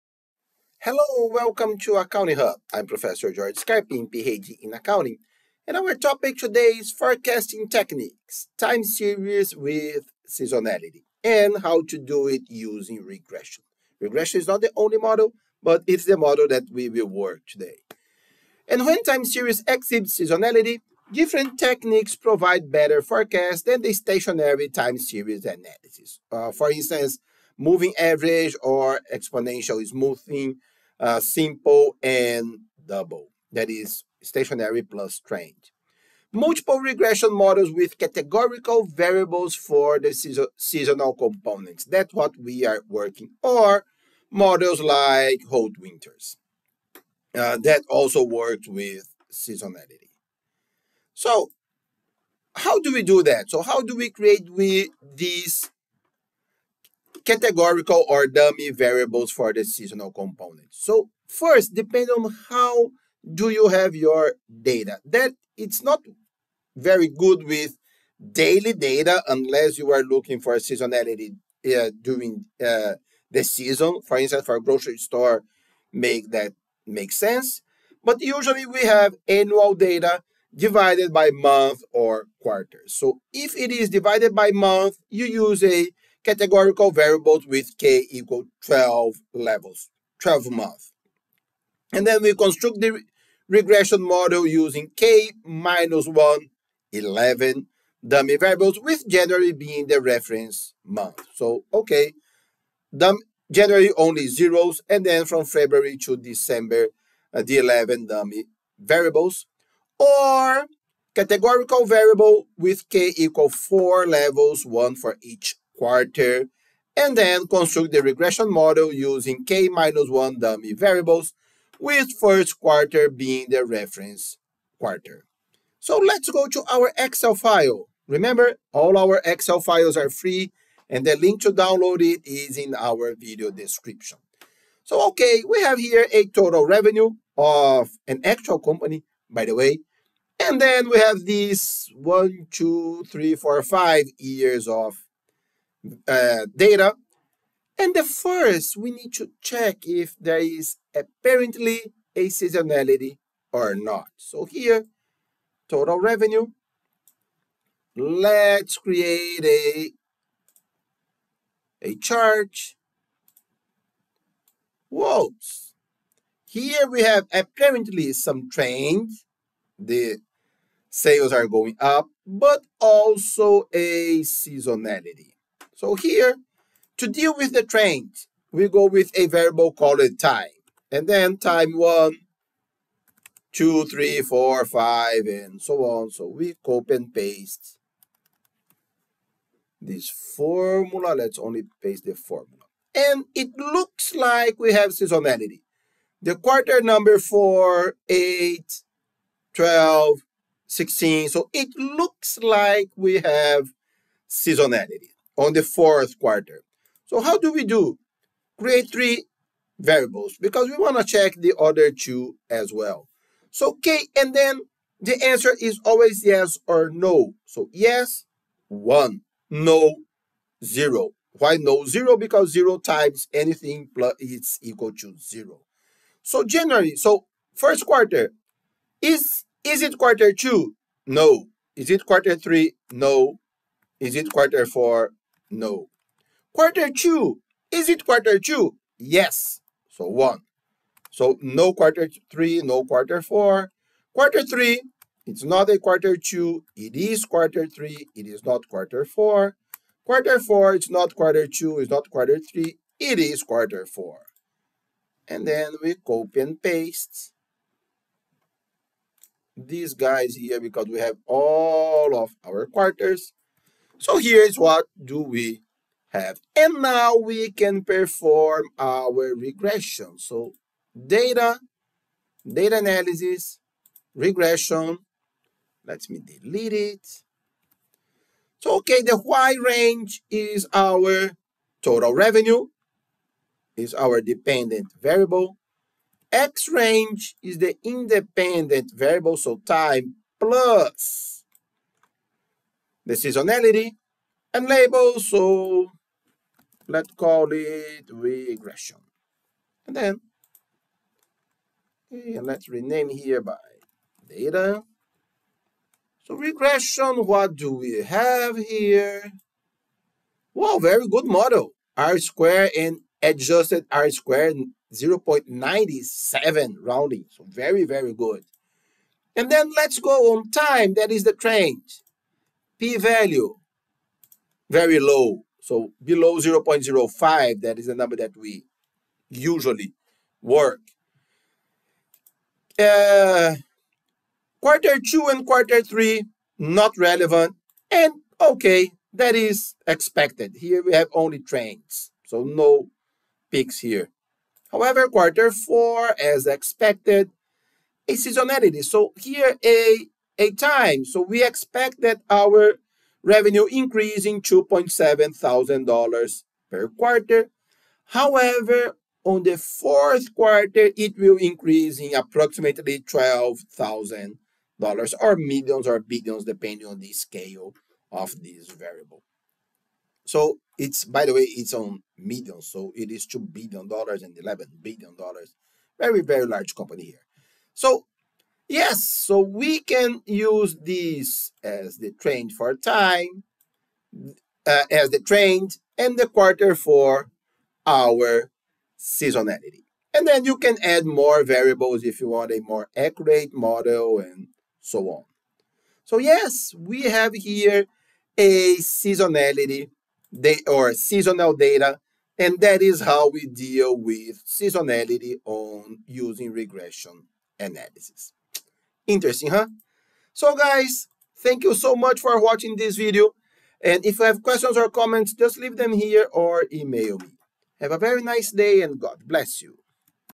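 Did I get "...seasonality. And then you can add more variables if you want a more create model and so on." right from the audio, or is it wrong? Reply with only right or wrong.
wrong.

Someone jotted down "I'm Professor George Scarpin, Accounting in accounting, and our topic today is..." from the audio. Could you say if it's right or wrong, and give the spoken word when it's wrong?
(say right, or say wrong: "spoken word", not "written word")
wrong: "PhD", not "Accounting".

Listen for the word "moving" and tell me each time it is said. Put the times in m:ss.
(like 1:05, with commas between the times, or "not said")
0:27.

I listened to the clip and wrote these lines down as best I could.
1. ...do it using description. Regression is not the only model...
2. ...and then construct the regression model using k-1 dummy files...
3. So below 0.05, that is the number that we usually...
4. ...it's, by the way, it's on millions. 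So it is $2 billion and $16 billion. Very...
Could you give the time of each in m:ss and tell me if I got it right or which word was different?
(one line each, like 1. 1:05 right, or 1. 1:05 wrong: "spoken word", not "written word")
1. 0:11 wrong: "regression", not "description"
2. 1:56 wrong: "variables", not "files"
3. 5:25 right
4. 6:10 wrong: "11", not "16".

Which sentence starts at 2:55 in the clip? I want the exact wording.
So here, to deal with the trends, we go with a variable called time.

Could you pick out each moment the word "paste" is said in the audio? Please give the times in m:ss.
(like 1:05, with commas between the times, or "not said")
3:07, 3:11, 4:16.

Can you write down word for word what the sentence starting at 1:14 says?
For instance, for a grocery store, make that make sense.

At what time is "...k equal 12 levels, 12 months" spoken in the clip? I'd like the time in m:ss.
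1:27.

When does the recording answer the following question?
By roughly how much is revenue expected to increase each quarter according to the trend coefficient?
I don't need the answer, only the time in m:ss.
5:54.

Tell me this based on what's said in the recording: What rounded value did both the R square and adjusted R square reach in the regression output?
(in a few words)
0.97.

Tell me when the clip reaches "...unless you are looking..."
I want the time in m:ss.
1:09.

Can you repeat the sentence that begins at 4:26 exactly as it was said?
And now we can perform our regression.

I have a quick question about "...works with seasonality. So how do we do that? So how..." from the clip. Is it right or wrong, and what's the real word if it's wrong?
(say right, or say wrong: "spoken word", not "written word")
right.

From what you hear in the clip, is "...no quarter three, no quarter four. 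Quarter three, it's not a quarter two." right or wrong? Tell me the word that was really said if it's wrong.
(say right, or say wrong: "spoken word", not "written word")
right.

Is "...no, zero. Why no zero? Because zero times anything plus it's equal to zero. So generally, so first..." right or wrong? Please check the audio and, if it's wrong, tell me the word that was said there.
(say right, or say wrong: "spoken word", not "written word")
right.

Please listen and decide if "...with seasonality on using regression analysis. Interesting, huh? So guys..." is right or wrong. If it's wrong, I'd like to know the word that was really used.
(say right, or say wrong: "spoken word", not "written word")
right.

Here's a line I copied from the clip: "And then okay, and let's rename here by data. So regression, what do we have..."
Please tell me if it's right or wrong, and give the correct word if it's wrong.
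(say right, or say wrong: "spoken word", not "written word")
right.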